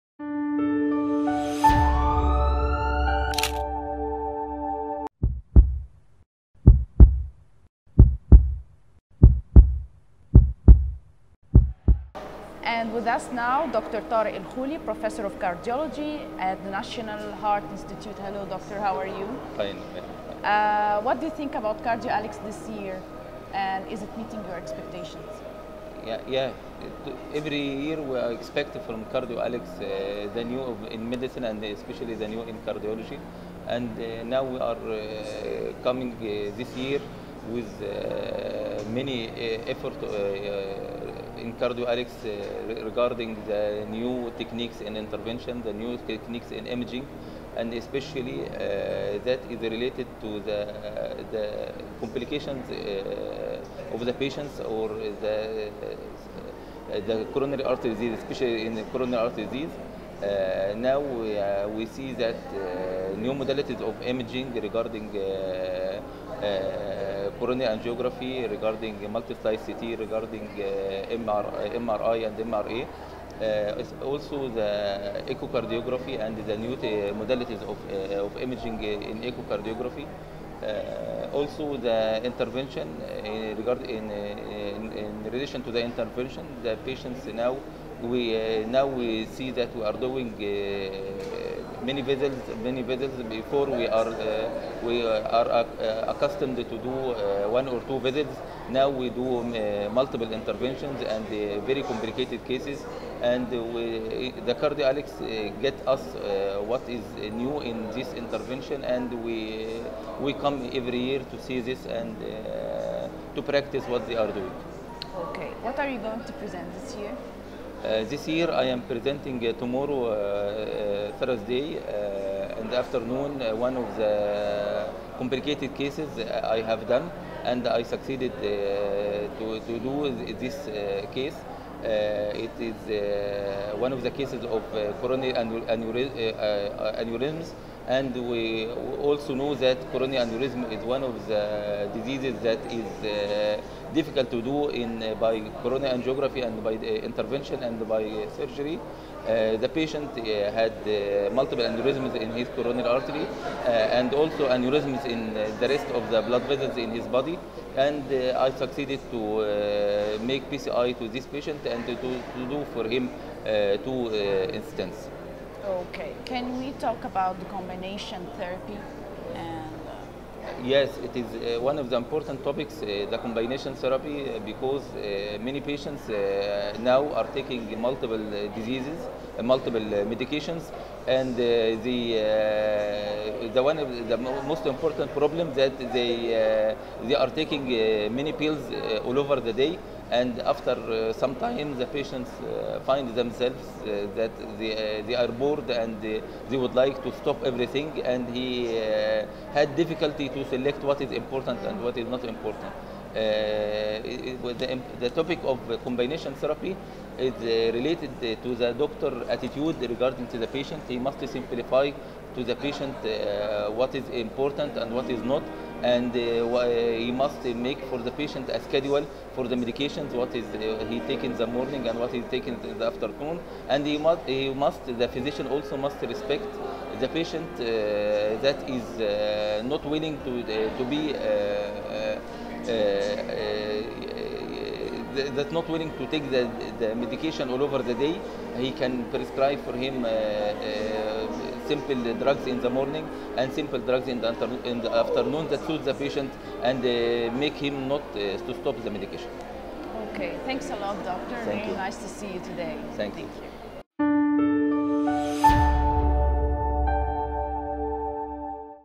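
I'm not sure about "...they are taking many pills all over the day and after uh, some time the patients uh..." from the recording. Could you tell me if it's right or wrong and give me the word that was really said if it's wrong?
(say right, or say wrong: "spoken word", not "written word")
right.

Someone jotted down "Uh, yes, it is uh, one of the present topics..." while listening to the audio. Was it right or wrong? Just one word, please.
wrong.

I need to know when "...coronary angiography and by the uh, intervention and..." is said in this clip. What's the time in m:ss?
2:25.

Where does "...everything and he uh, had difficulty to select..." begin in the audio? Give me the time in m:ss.
3:17.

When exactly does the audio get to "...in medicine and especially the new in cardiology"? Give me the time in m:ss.
0:30.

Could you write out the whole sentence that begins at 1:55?
Okay, what are you going to present this year?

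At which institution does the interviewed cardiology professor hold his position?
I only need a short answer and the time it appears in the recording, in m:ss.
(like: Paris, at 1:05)
National Heart Institute, at 0:16.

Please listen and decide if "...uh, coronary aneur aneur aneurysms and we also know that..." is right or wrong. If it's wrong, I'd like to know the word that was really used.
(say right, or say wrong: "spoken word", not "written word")
right.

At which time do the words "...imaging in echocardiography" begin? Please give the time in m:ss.
1:18.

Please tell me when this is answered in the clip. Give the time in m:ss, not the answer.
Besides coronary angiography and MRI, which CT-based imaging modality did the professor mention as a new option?
1:09.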